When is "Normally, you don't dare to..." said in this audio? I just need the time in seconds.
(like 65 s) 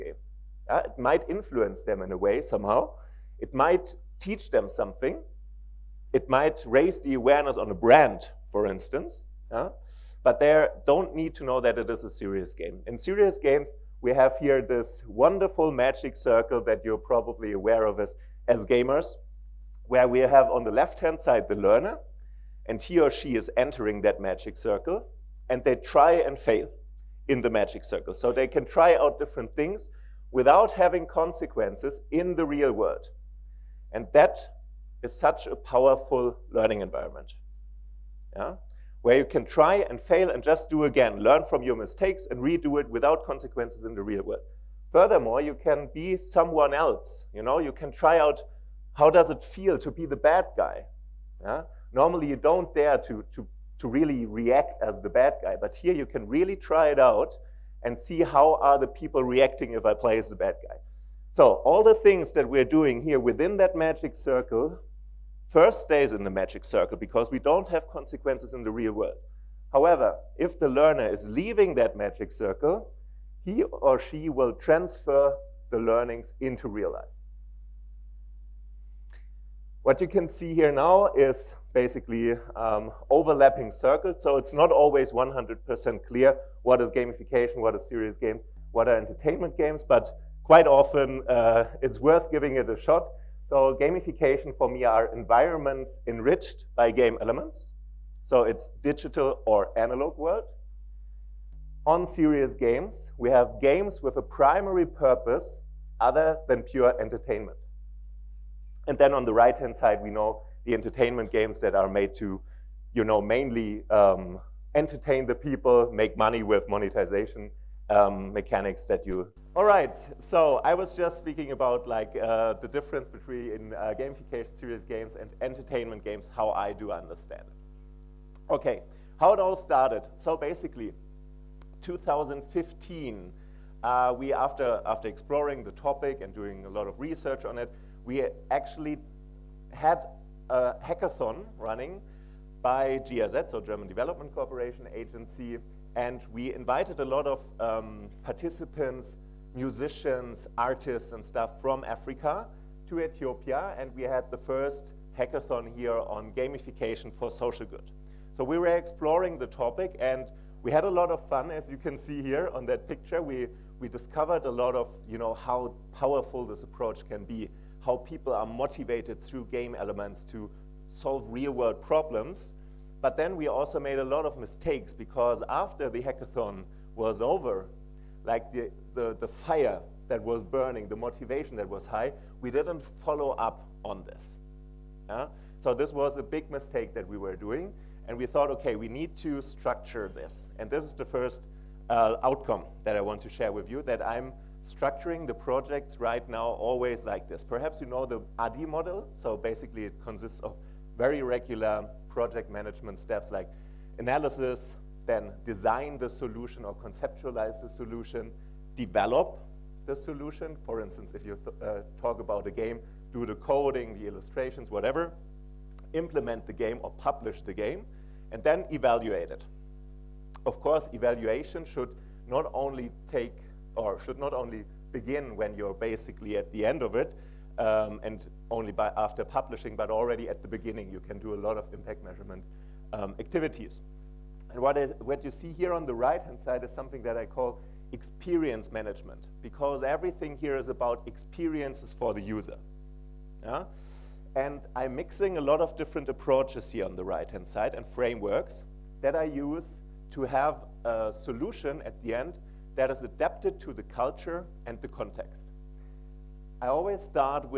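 51 s.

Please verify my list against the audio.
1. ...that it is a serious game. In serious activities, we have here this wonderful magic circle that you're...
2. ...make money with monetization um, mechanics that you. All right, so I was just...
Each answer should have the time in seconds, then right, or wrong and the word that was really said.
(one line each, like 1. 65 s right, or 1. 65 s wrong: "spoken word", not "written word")
1. 11 s wrong: "games", not "activities"
2. 115 s right.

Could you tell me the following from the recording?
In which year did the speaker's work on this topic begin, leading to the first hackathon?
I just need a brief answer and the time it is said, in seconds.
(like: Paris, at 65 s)
2015, at 131 s.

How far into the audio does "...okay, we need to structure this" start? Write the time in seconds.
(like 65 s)
188 s.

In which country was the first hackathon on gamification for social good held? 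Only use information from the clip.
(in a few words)
Ethiopia.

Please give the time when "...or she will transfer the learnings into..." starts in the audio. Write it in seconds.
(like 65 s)
73 s.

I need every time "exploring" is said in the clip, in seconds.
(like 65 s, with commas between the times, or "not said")
135 s, 158 s.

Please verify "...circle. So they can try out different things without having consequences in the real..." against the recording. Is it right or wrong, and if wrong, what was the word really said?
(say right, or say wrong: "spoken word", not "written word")
right.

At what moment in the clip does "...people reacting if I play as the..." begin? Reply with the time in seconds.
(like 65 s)
58 s.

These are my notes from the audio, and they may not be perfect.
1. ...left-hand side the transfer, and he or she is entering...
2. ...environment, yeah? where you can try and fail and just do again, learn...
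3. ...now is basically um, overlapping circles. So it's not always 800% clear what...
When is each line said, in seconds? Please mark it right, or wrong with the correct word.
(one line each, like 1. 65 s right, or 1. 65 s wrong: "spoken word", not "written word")
1. 20 s wrong: "learner", not "transfer"
2. 36 s right
3. 80 s wrong: "100", not "800".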